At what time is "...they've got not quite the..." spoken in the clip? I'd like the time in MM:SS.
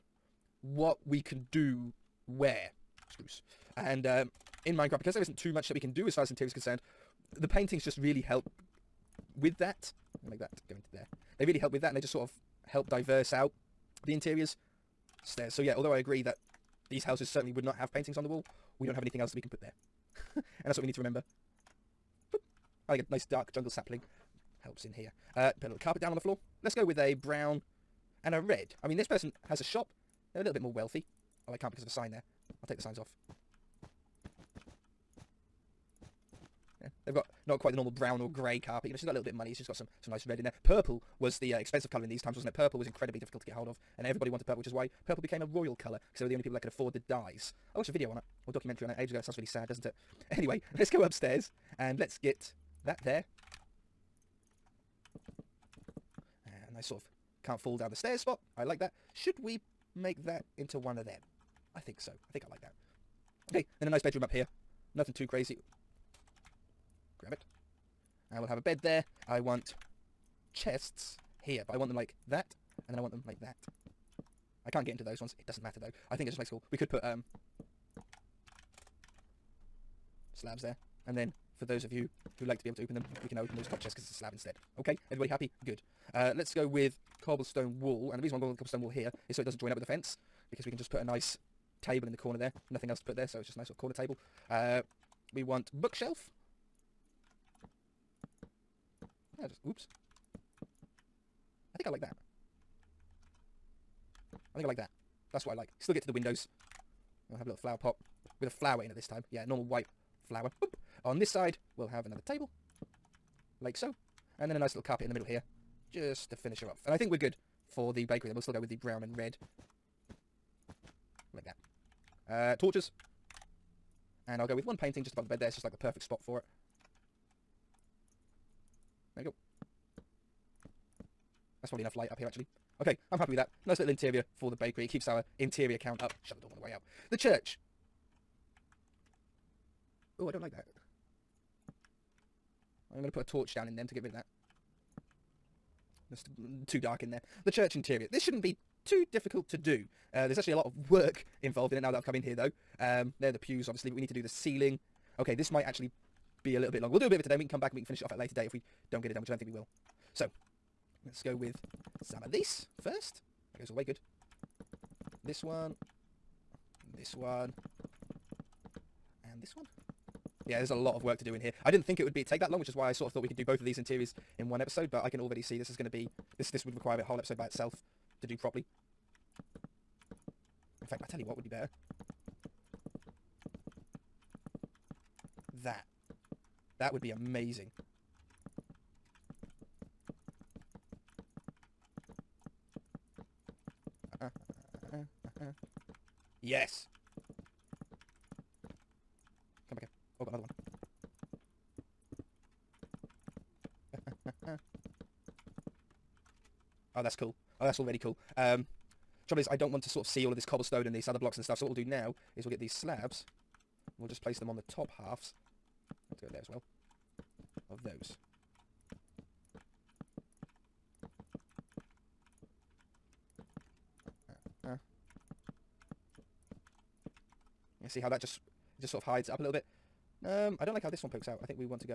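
00:37.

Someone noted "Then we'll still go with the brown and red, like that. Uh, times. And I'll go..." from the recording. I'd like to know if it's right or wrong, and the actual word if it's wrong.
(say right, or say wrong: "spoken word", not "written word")
wrong: "torches", not "times".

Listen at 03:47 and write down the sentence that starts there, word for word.
see how that just just sort of hides it up a little bit.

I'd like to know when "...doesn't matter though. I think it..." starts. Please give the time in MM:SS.
01:15.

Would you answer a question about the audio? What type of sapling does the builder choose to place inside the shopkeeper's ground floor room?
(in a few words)
Dark jungle sapling.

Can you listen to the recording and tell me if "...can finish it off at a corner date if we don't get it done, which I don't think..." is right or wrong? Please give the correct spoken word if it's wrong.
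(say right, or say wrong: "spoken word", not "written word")
wrong: "later", not "corner".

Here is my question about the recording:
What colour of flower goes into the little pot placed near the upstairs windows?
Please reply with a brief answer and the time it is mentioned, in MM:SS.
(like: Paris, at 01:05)
White, at 01:49.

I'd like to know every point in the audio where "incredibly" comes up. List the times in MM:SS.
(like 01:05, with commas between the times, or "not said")
00:42.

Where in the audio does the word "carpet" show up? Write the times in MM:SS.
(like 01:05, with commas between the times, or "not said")
00:25, 00:38, 01:54.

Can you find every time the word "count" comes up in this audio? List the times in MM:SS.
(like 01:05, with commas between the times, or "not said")
02:15.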